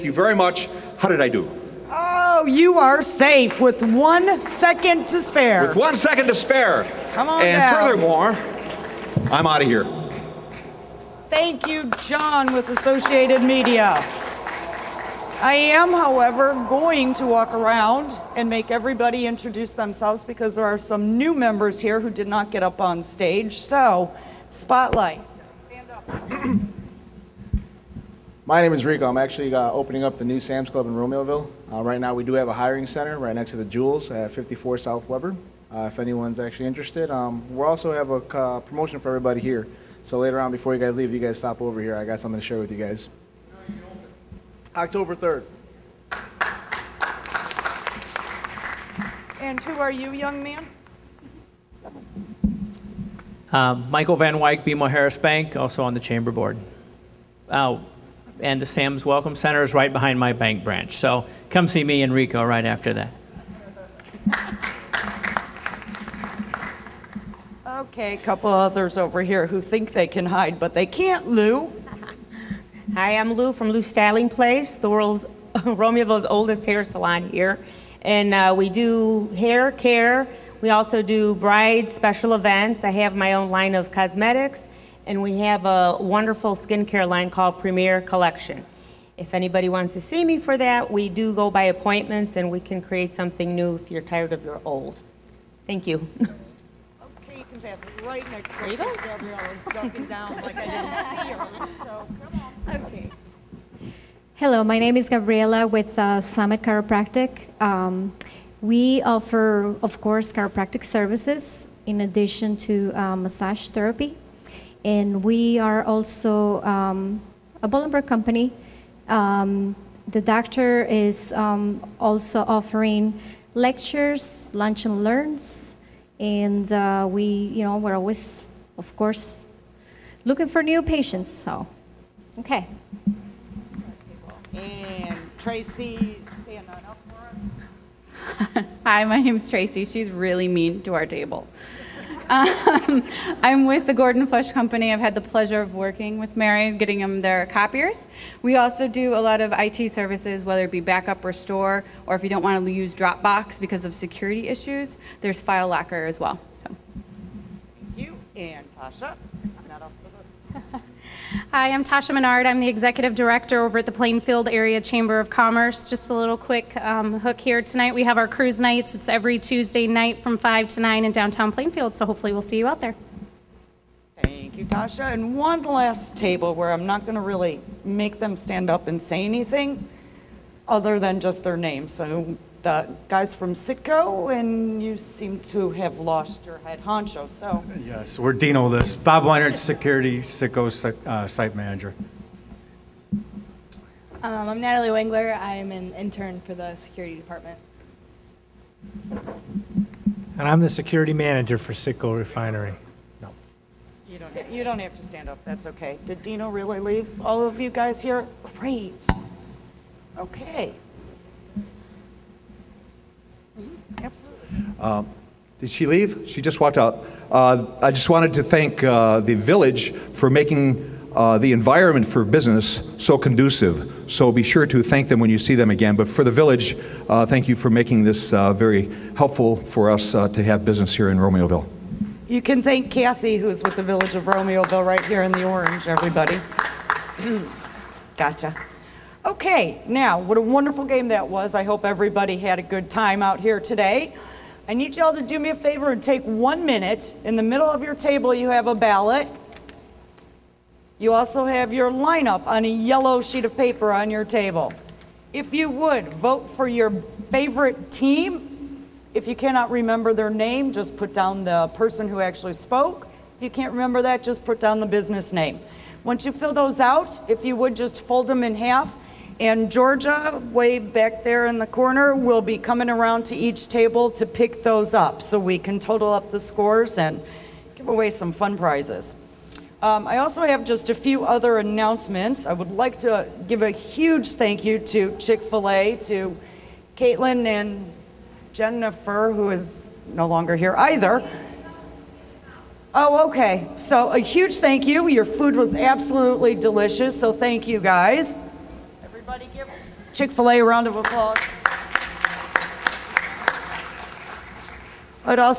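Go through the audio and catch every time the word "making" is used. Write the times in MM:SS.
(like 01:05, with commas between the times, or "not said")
03:40, 03:47.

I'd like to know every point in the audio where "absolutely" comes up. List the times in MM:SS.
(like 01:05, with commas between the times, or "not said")
03:34, 04:55.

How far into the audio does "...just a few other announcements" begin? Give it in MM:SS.
04:40.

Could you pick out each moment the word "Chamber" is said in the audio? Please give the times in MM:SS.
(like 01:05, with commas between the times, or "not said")
00:55, 02:44.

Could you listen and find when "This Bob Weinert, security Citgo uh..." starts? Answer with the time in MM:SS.
03:08.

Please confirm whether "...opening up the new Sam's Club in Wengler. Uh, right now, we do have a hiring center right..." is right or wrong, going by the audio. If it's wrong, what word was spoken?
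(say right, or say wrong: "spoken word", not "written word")
wrong: "Romeoville", not "Wengler".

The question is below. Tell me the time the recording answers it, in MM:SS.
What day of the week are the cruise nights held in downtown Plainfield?
02:49.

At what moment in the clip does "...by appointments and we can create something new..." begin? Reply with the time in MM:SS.
01:31.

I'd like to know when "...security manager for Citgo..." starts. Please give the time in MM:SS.
03:20.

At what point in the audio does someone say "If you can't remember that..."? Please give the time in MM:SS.
04:23.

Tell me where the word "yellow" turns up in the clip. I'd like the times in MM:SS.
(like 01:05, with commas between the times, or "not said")
04:12.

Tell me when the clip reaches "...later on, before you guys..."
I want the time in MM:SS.
00:40.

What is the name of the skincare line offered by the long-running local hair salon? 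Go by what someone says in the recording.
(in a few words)
Premier Collection.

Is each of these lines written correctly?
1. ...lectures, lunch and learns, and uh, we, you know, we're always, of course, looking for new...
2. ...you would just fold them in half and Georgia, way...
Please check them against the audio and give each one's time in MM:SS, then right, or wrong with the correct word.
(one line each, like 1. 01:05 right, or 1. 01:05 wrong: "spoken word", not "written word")
1. 02:03 right
2. 04:27 right.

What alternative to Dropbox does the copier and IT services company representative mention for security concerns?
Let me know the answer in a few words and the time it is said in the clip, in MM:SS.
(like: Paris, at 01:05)
File Locker, at 02:35.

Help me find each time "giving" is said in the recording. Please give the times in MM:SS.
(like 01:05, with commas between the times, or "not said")
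not said.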